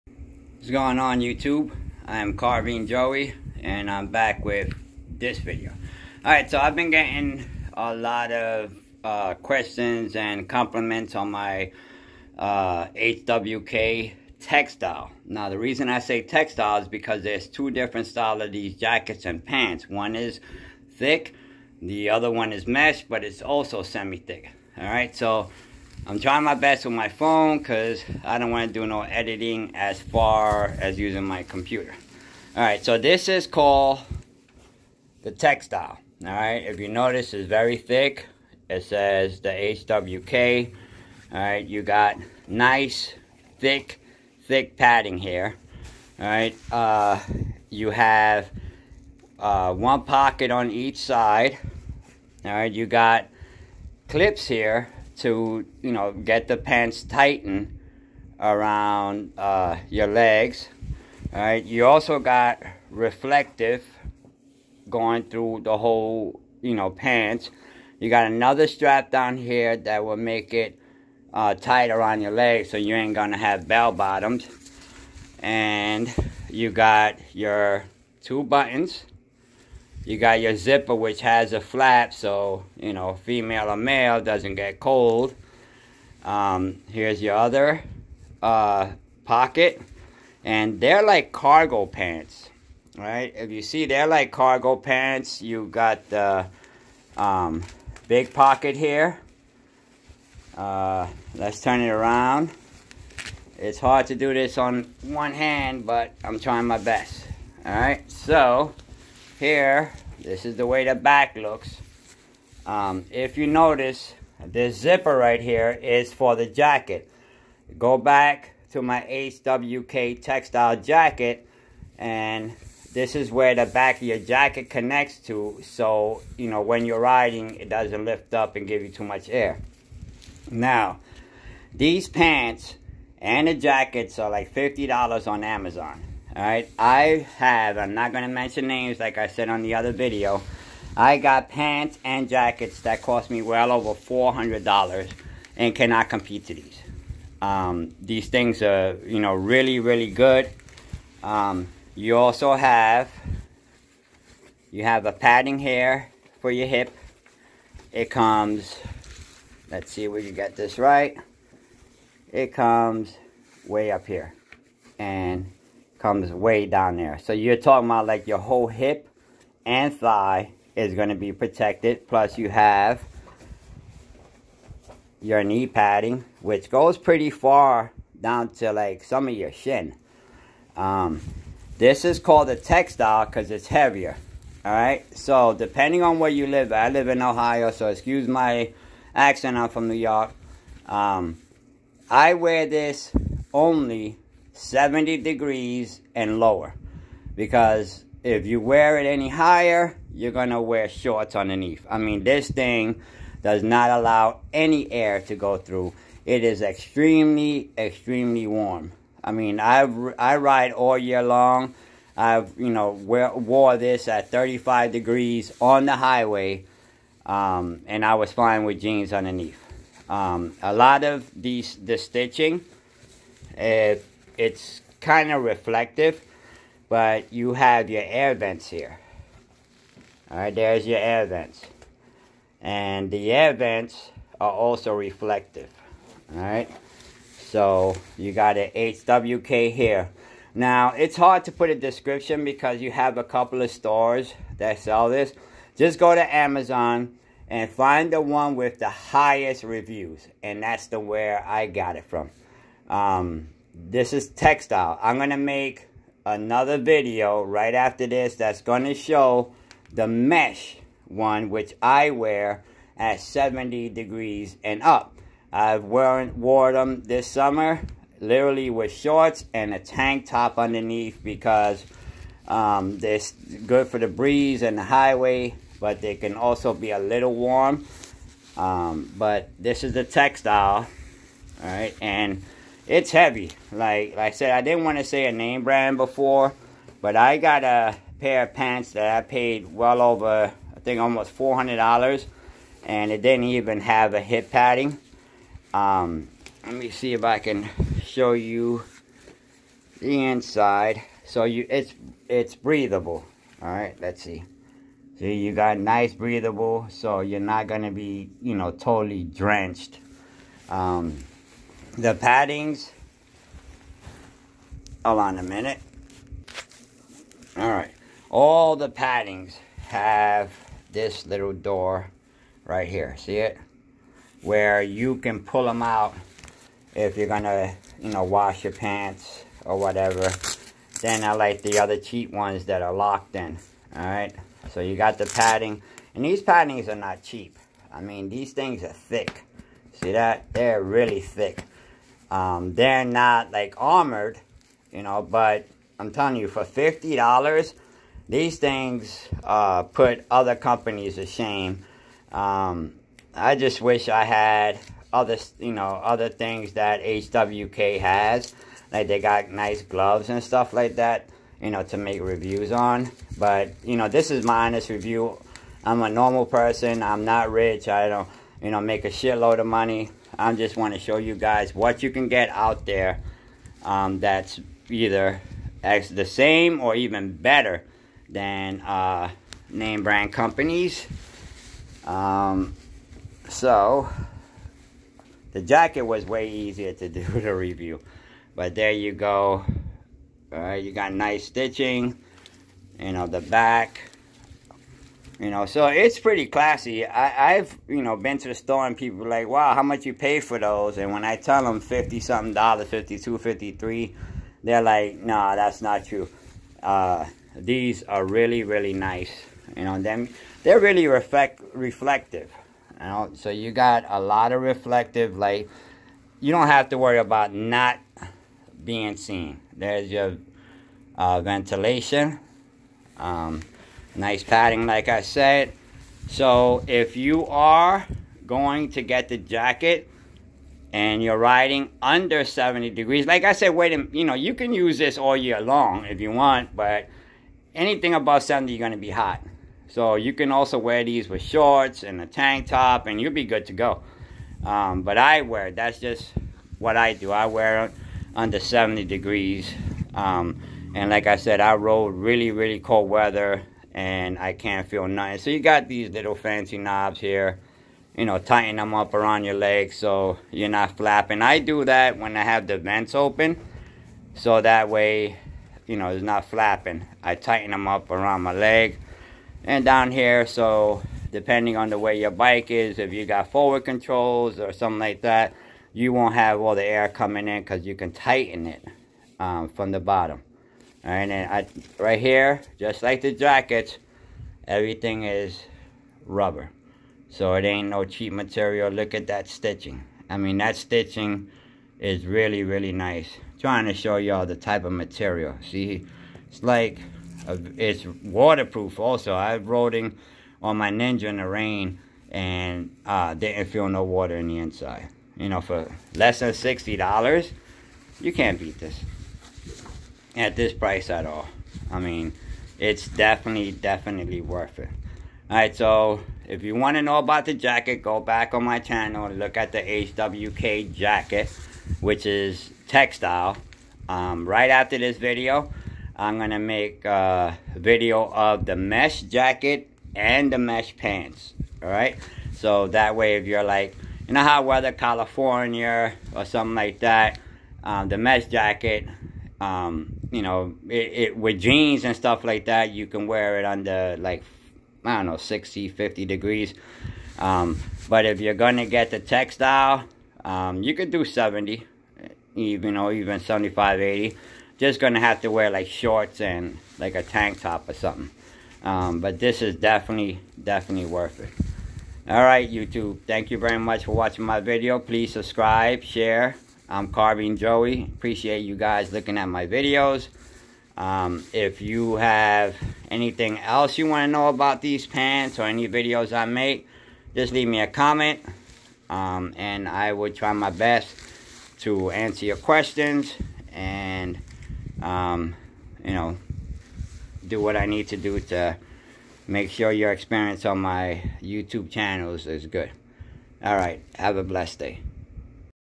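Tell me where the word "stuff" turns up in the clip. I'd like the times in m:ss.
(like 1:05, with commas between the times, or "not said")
6:00, 9:02.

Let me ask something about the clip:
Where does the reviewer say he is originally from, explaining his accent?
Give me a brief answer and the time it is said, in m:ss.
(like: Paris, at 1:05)
New York, at 3:09.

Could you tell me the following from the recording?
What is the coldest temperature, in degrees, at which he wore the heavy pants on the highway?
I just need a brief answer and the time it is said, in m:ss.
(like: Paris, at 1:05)
35, at 3:34.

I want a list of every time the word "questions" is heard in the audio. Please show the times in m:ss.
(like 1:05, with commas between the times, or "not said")
0:09, 9:42.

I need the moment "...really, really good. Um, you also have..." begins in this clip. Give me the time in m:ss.
2:29.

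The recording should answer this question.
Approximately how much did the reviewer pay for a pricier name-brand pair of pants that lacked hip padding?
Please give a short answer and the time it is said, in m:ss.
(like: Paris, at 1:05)
almost $400, at 4:50.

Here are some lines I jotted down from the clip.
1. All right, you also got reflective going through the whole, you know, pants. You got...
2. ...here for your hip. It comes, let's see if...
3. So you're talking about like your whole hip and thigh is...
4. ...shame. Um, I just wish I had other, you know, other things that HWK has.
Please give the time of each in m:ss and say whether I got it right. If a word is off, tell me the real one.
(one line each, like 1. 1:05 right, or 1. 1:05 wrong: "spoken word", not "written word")
1. 1:01 right
2. 2:35 right
3. 2:47 right
4. 5:51 right.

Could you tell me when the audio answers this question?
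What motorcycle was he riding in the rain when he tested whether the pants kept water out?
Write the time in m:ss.
8:20.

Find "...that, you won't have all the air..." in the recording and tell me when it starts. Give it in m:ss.
7:55.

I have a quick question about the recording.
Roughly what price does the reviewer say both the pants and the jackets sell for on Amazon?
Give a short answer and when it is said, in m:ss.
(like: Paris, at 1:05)
$50, at 2:14.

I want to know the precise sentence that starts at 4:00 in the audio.
Now, it's hard to put a description because you have a couple of stores that sell this.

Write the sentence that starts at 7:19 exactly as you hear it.
So you can also wear these with shorts and a tank top and you'll be good to go.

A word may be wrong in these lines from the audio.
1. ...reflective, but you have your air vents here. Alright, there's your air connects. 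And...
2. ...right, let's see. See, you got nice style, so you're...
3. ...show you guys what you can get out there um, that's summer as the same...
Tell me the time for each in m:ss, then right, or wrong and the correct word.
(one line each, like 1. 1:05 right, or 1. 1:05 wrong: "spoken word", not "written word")
1. 3:45 wrong: "vents", not "connects"
2. 5:03 wrong: "breathable", not "style"
3. 6:10 wrong: "either", not "summer".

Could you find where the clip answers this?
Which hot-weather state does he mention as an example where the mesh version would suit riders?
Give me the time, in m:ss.
8:54.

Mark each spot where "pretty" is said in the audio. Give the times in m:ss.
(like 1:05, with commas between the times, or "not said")
2:56, 6:36.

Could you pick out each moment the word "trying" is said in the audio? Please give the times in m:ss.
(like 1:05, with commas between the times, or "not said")
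0:26, 1:46, 8:13.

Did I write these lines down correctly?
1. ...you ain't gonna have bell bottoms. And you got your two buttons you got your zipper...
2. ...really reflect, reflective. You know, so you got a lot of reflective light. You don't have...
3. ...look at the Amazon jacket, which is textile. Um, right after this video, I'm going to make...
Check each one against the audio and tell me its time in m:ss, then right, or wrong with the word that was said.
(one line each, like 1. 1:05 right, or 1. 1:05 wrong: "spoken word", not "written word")
1. 1:12 right
2. 6:50 right
3. 8:39 wrong: "HWK", not "Amazon".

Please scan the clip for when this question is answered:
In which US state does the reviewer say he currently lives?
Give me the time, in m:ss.
3:06.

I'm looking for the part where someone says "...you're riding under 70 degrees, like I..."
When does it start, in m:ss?
7:11.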